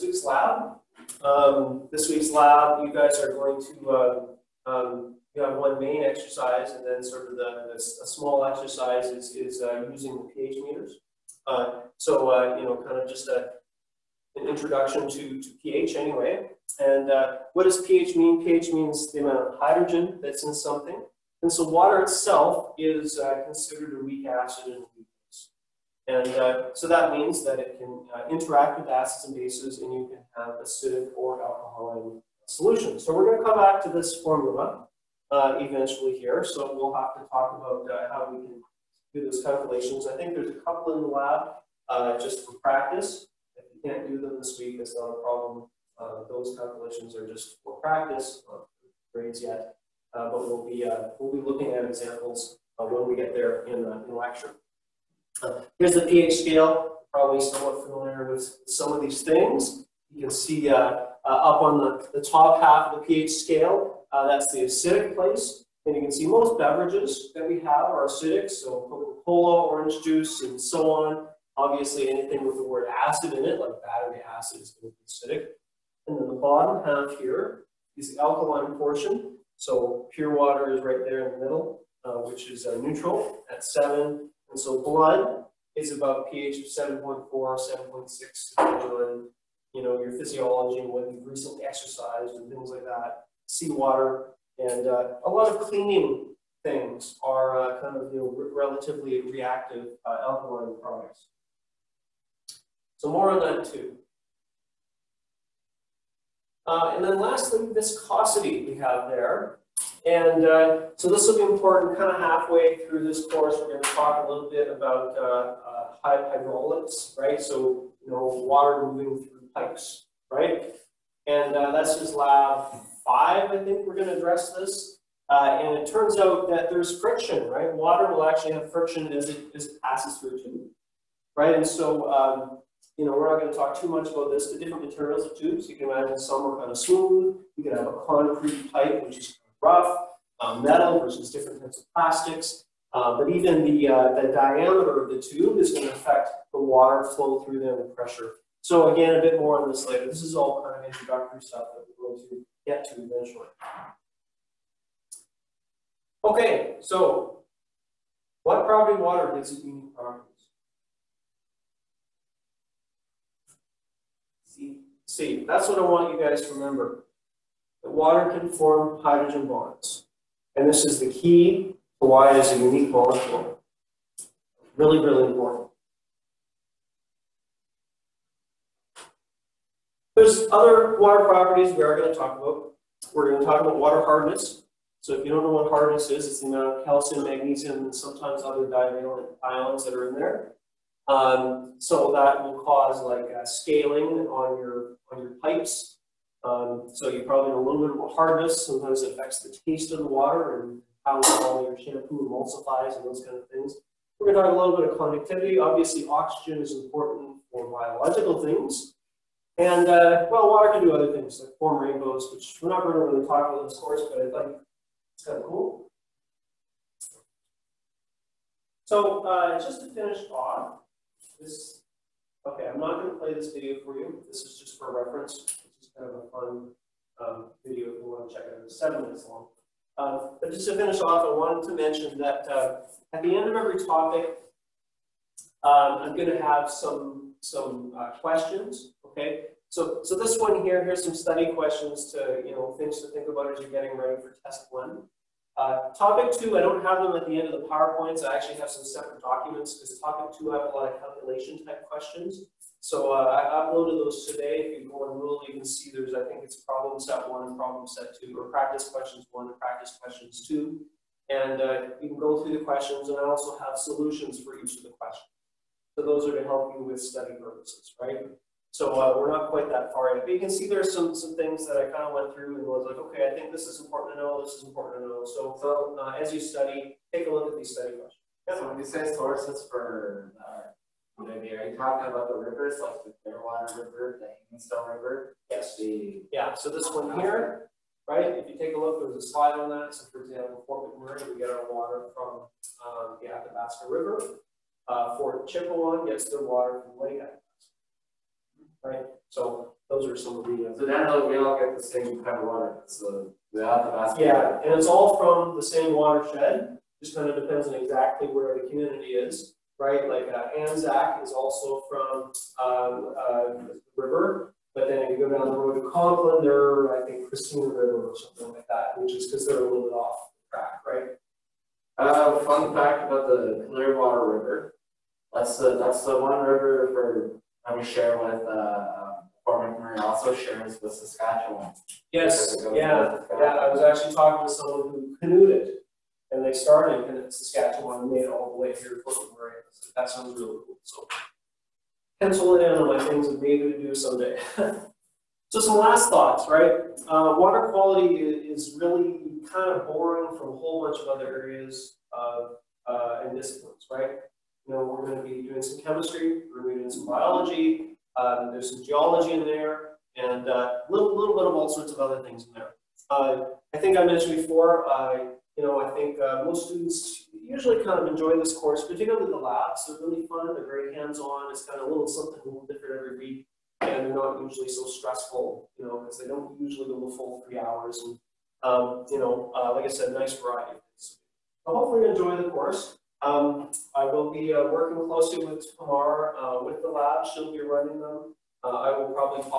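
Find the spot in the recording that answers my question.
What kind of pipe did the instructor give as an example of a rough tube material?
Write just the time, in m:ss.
2:18.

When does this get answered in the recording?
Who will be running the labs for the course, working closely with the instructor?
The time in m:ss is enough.
6:25.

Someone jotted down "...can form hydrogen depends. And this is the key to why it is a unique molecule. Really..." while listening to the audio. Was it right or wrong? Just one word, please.
wrong.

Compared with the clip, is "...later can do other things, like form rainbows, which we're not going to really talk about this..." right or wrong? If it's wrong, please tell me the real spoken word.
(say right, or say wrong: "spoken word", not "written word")
wrong: "water", not "later".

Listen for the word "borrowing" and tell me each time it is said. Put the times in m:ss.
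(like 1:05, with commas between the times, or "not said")
5:49.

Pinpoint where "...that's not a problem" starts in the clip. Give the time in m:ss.
0:44.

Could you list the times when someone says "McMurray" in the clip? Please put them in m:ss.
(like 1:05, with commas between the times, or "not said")
4:50, 5:29.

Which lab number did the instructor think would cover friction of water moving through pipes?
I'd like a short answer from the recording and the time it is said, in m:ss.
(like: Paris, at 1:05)
5, at 2:02.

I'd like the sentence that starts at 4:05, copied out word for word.
Uh, topic two, I don't have them at the end of the PowerPoints.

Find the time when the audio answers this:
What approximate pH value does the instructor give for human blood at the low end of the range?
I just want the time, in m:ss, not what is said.
1:26.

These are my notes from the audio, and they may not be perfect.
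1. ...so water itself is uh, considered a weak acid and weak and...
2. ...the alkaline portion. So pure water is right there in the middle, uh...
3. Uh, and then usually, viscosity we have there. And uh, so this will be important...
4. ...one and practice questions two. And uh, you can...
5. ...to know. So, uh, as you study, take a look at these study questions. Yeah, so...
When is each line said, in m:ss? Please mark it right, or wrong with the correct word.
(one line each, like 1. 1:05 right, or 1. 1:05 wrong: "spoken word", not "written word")
1. 0:21 right
2. 1:18 right
3. 1:46 wrong: "lastly", not "usually"
4. 4:19 right
5. 4:35 right.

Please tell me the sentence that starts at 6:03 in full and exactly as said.
Uh, I think I mentioned before, uh, you know, I think most students usually kind of enjoy this course, particularly the labs.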